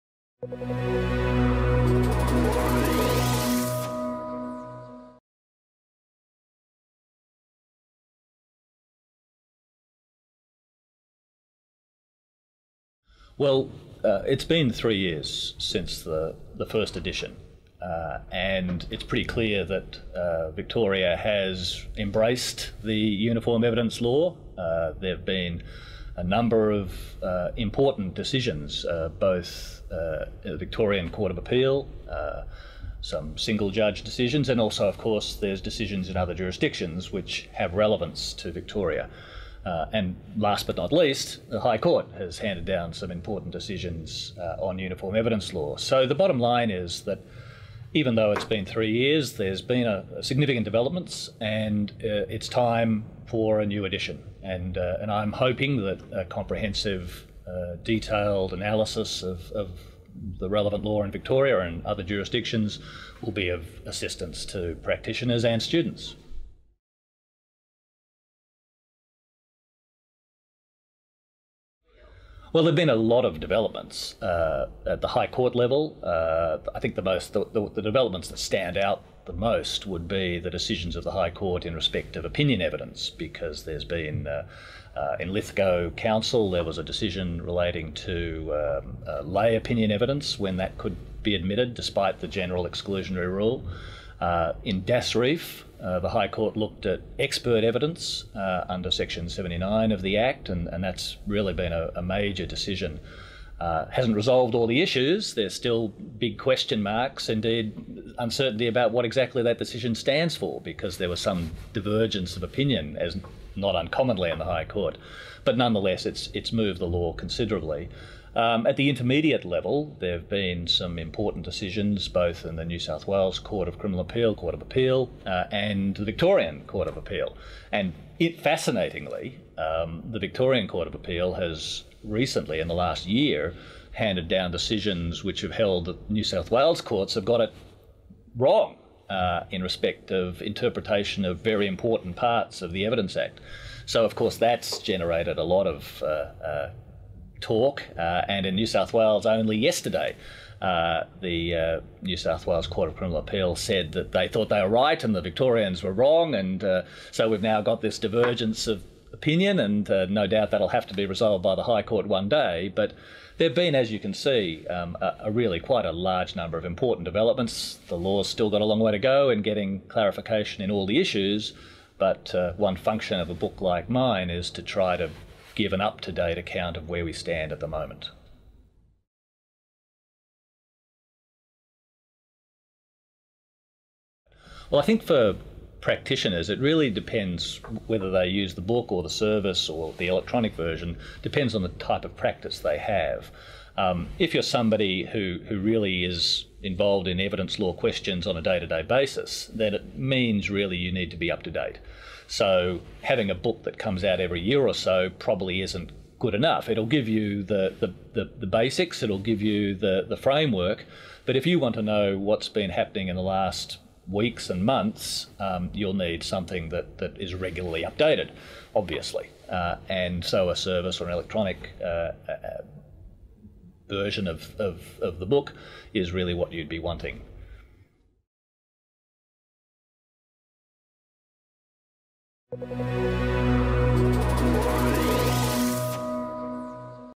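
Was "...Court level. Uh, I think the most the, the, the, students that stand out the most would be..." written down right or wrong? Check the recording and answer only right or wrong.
wrong.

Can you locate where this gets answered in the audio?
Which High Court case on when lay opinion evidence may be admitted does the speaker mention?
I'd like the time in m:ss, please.
1:25.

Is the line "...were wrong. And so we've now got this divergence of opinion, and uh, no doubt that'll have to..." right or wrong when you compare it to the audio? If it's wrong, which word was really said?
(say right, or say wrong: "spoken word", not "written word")
right.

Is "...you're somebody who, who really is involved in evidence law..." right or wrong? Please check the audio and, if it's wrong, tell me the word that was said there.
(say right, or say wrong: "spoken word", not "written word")
right.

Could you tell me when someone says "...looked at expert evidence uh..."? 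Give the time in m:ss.
1:36.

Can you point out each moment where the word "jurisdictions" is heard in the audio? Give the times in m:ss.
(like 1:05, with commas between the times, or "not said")
0:36, 1:02.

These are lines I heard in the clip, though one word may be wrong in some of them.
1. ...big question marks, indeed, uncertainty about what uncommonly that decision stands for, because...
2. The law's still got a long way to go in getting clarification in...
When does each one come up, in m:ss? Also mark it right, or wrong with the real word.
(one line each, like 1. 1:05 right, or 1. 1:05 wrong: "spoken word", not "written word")
1. 1:45 wrong: "exactly", not "uncommonly"
2. 2:47 right.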